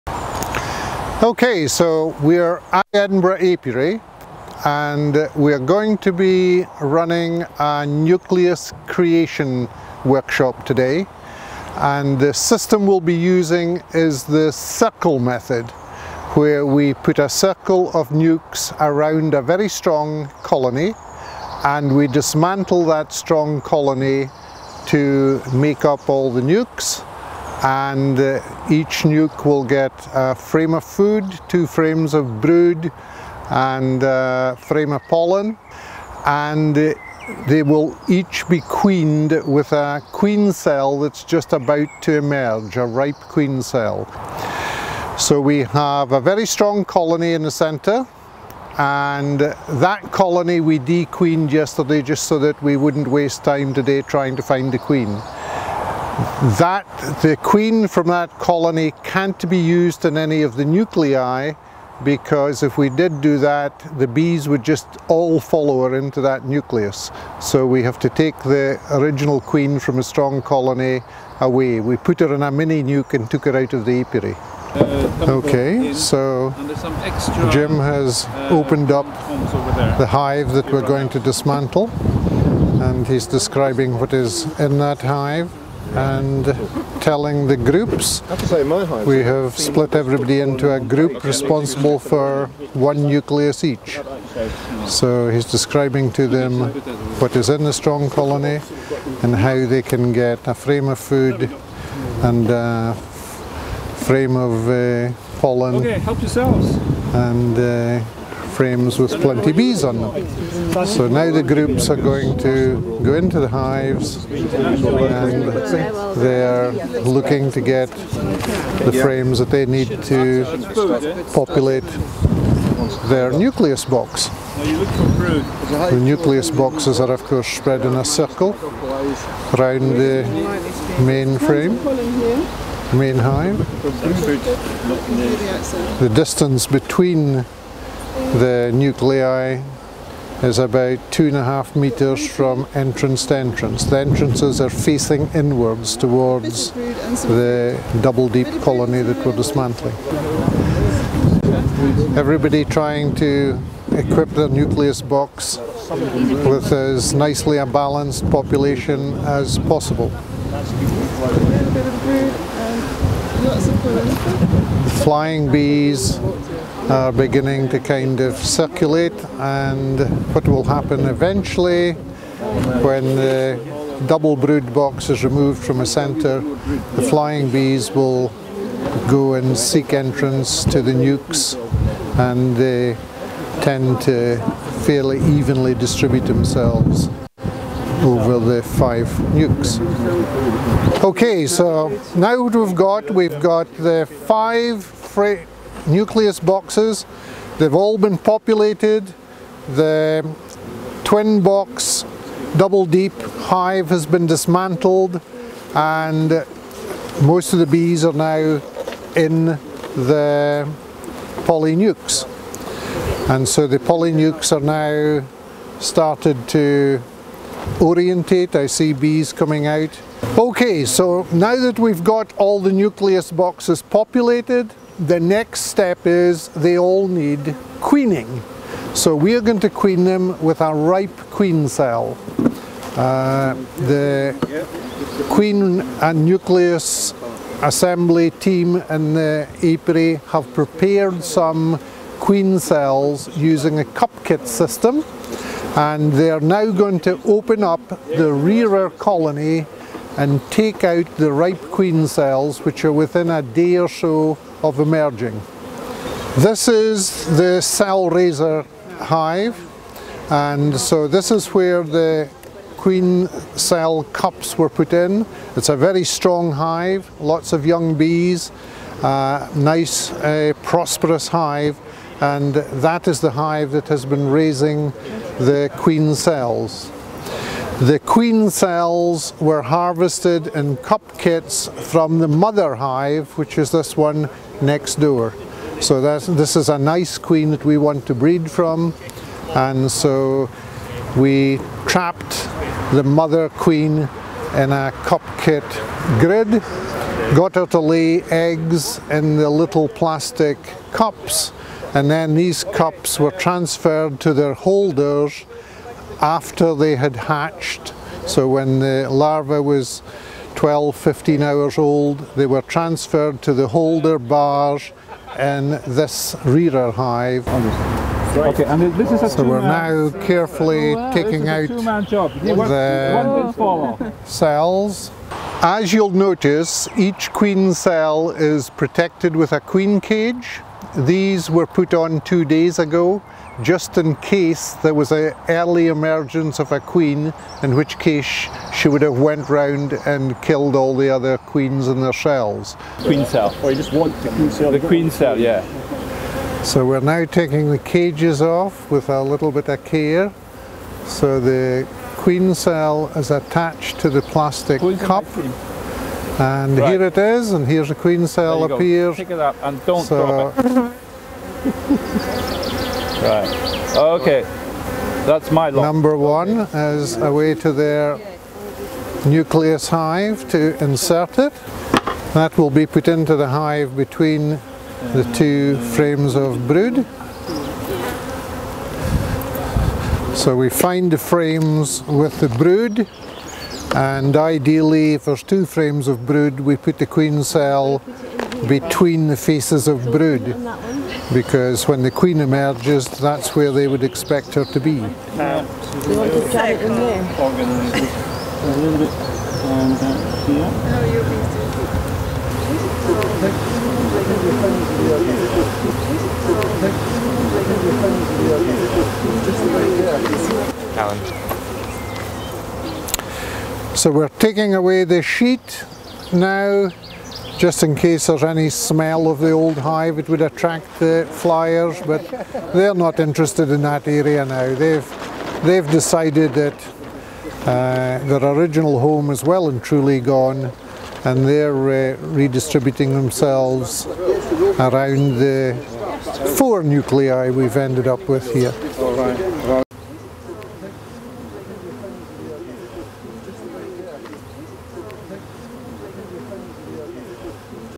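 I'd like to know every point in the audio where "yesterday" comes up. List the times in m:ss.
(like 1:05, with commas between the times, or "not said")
0:51.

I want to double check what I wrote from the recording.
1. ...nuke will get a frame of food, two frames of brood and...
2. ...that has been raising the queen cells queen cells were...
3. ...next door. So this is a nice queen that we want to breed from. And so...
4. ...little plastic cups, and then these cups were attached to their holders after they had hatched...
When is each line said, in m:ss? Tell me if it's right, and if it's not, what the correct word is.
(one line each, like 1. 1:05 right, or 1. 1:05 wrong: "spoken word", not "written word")
1. 0:29 right
2. 4:33 right
3. 4:44 right
4. 4:59 wrong: "transferred", not "attached".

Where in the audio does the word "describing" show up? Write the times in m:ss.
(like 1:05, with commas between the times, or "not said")
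1:23, 1:35.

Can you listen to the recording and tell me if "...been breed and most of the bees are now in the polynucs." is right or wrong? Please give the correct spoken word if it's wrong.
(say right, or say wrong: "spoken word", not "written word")
wrong: "dismantled", not "breed".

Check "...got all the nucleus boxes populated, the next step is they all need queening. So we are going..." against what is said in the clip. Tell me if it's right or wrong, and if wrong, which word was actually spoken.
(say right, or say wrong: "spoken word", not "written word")
right.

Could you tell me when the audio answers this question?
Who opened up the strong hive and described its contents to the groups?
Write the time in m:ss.
1:17.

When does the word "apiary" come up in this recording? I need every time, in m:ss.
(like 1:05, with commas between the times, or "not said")
0:03, 1:14, 3:59.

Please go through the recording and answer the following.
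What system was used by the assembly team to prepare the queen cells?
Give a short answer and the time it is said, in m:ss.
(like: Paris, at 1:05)
Cup kit system, at 4:03.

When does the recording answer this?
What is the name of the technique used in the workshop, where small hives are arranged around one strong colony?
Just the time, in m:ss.
0:14.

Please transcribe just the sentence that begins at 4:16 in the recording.
This is the cell raiser hive and so this is where the queen cell cups were put in.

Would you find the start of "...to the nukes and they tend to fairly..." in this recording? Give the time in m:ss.
3:00.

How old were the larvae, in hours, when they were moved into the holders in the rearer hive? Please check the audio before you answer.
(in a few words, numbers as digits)
12 to 15 hours.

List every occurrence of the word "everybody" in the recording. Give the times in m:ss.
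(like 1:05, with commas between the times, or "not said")
1:29, 2:32.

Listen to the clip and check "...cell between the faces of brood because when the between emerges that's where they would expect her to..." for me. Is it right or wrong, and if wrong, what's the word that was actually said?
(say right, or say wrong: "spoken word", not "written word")
wrong: "queen", not "between".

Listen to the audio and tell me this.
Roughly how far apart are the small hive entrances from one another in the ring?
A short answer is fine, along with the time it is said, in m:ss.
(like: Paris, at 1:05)
2.5 meters, at 2:21.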